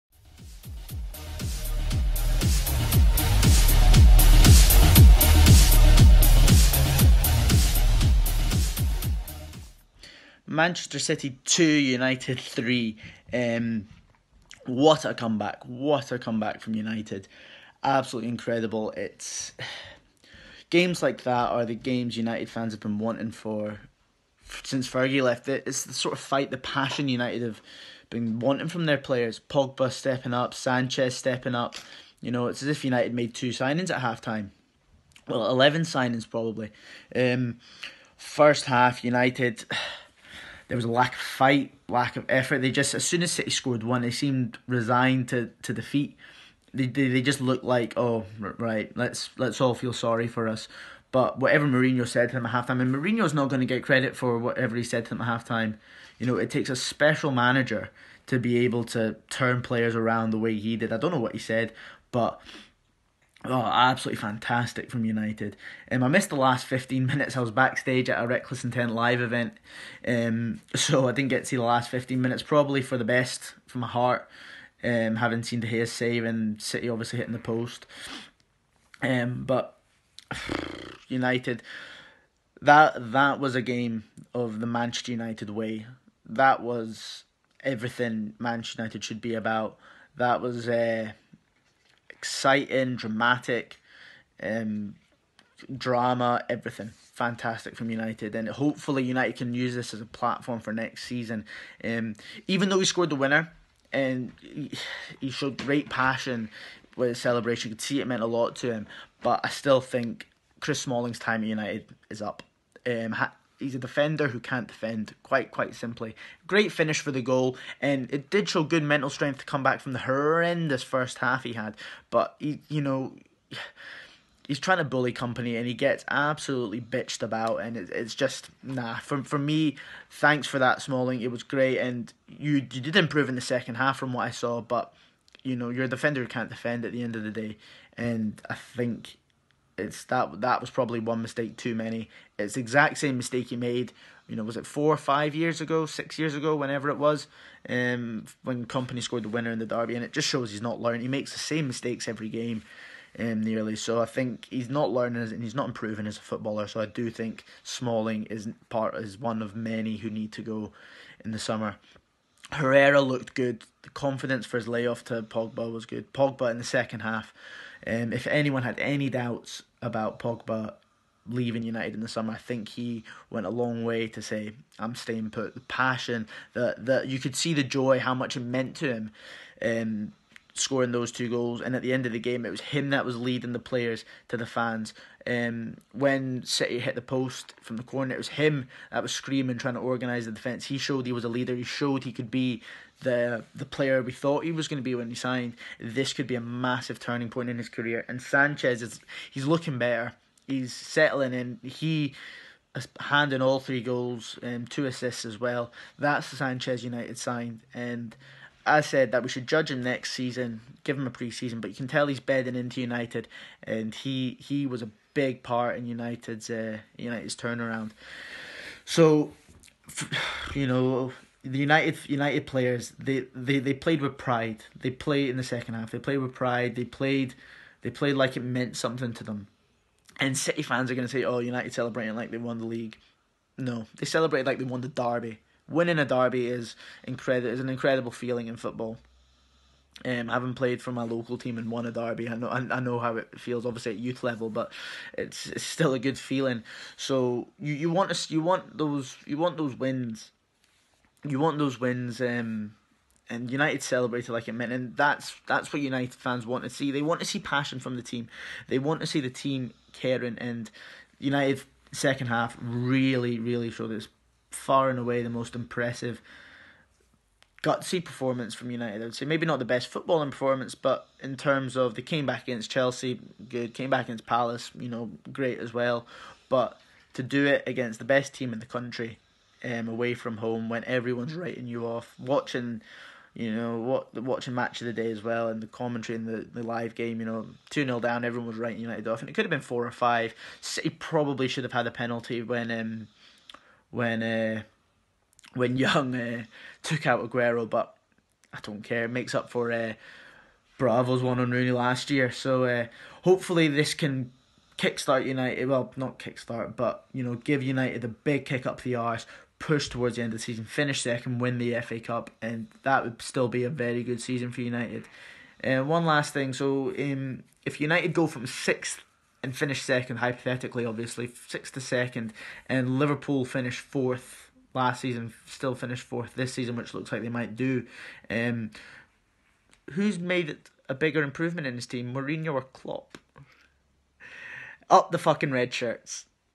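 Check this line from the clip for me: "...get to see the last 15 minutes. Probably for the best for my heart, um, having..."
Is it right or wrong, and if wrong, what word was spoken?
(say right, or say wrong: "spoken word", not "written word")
right.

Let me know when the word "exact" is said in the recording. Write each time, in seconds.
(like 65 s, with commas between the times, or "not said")
142 s.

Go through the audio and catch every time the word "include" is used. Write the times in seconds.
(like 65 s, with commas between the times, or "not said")
not said.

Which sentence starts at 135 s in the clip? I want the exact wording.
You know, you're a defender who can't defend at the end of the day.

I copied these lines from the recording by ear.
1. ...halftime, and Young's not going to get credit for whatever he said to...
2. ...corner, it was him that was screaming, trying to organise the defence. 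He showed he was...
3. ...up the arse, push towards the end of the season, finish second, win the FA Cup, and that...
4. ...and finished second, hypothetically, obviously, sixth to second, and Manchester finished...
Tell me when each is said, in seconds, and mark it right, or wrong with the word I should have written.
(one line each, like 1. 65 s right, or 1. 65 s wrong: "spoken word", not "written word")
1. 52 s wrong: "Mourinho", not "Young"
2. 187 s right
3. 308 s right
4. 319 s wrong: "Liverpool", not "Manchester".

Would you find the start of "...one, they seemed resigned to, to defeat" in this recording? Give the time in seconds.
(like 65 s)
43 s.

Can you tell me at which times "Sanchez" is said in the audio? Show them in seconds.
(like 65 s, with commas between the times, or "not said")
30 s, 198 s, 206 s.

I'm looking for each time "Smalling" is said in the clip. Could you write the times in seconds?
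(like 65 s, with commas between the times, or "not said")
110 s, 130 s, 157 s.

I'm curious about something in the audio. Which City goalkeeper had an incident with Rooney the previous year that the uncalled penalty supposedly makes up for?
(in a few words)
Bravo.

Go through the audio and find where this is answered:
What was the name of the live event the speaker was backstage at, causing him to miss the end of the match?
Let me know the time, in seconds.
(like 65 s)
68 s.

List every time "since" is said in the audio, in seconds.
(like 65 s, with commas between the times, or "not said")
24 s.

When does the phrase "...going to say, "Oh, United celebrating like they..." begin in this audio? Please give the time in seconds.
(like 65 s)
230 s.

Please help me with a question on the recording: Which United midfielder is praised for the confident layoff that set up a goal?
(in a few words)
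Herrera.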